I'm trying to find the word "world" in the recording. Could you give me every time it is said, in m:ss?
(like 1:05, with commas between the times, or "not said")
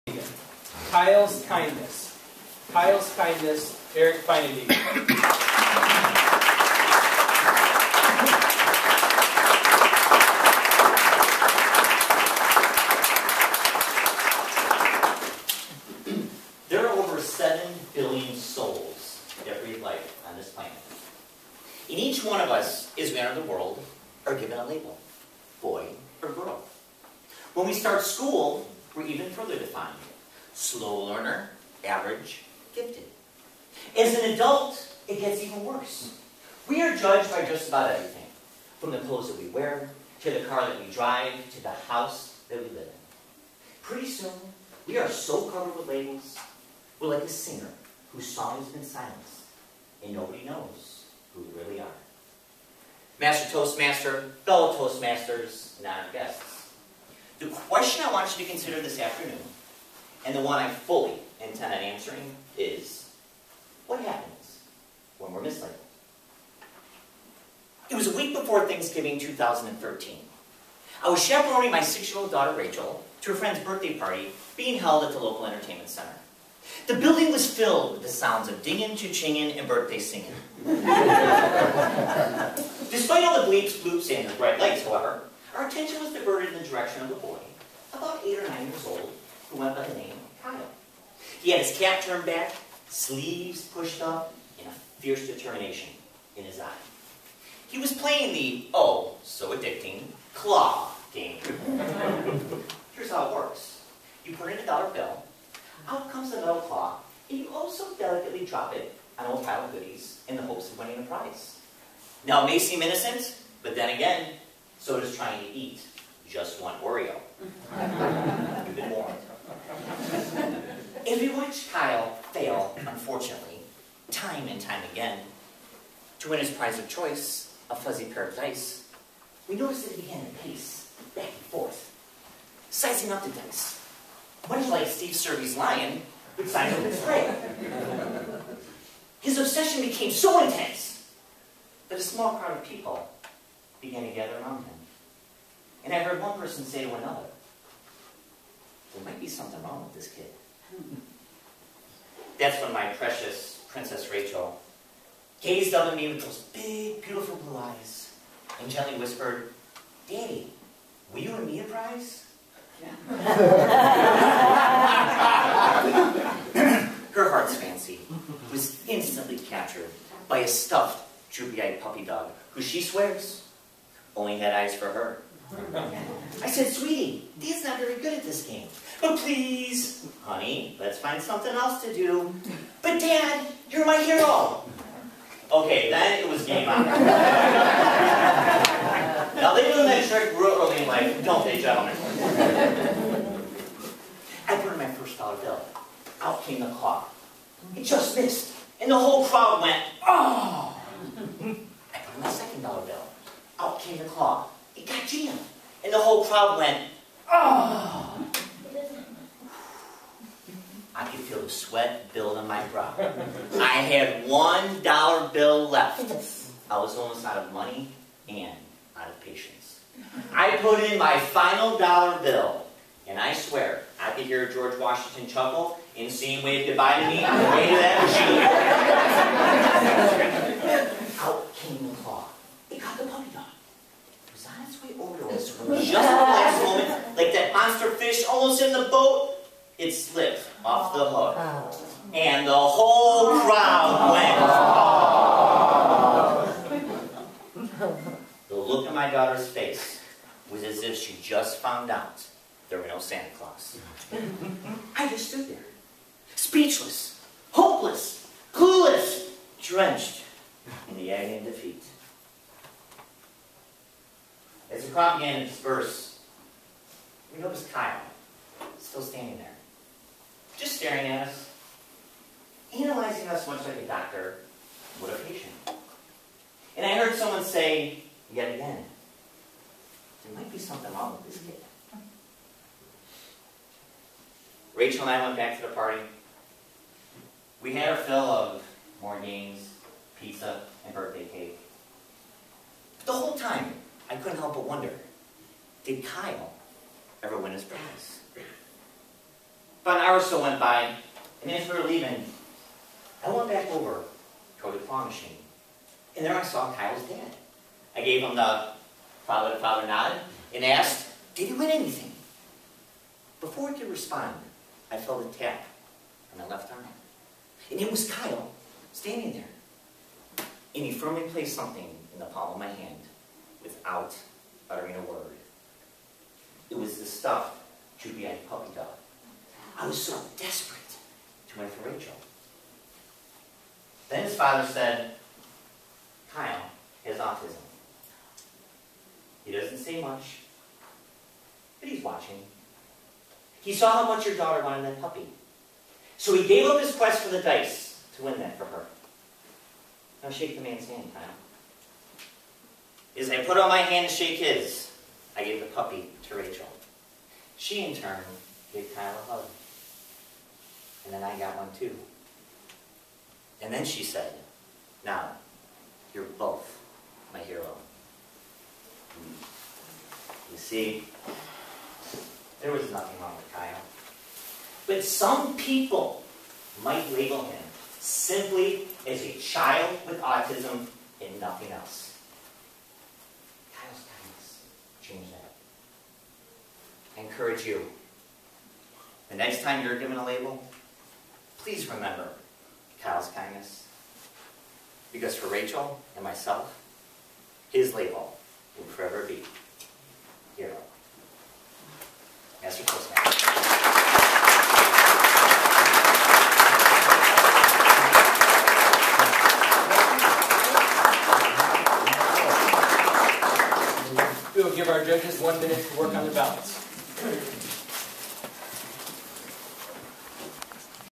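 0:23.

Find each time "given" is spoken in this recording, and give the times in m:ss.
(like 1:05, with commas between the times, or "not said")
0:24, 6:29.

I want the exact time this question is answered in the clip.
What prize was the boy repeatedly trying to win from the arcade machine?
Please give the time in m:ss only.
2:07.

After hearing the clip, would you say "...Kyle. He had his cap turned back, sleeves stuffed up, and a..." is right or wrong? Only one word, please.
wrong.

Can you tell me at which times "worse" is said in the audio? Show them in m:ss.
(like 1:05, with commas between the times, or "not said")
0:35.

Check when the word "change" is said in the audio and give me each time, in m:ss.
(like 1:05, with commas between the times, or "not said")
6:25.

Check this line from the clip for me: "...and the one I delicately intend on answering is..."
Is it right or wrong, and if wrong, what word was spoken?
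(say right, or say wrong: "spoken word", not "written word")
wrong: "fully", not "delicately".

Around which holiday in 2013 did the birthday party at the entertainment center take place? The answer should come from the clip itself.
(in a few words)
Thanksgiving.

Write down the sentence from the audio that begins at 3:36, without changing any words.
I was almost out of money and out of patience.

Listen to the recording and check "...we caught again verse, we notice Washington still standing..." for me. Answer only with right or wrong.
wrong.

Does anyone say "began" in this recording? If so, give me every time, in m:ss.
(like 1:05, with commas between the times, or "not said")
2:10, 2:23.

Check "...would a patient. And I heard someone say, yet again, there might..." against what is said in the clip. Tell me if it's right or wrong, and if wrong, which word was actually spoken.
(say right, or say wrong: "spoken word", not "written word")
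right.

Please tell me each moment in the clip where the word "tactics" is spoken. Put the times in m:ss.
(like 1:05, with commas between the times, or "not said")
not said.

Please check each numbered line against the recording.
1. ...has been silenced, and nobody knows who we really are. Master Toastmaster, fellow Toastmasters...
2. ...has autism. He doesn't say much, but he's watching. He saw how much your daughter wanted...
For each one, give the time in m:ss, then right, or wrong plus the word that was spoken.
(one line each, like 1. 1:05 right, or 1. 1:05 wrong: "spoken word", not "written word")
1. 0:48 right
2. 5:37 right.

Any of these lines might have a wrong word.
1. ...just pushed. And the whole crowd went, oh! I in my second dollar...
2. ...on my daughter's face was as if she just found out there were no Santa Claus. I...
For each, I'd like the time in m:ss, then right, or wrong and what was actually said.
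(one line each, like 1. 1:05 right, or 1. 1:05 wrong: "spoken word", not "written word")
1. 3:17 wrong: "missed", not "pushed"
2. 4:08 right.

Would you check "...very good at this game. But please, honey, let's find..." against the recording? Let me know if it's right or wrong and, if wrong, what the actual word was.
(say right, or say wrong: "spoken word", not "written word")
right.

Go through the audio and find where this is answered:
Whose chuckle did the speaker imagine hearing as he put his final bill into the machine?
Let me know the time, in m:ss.
3:44.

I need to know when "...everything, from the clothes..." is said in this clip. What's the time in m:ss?
0:37.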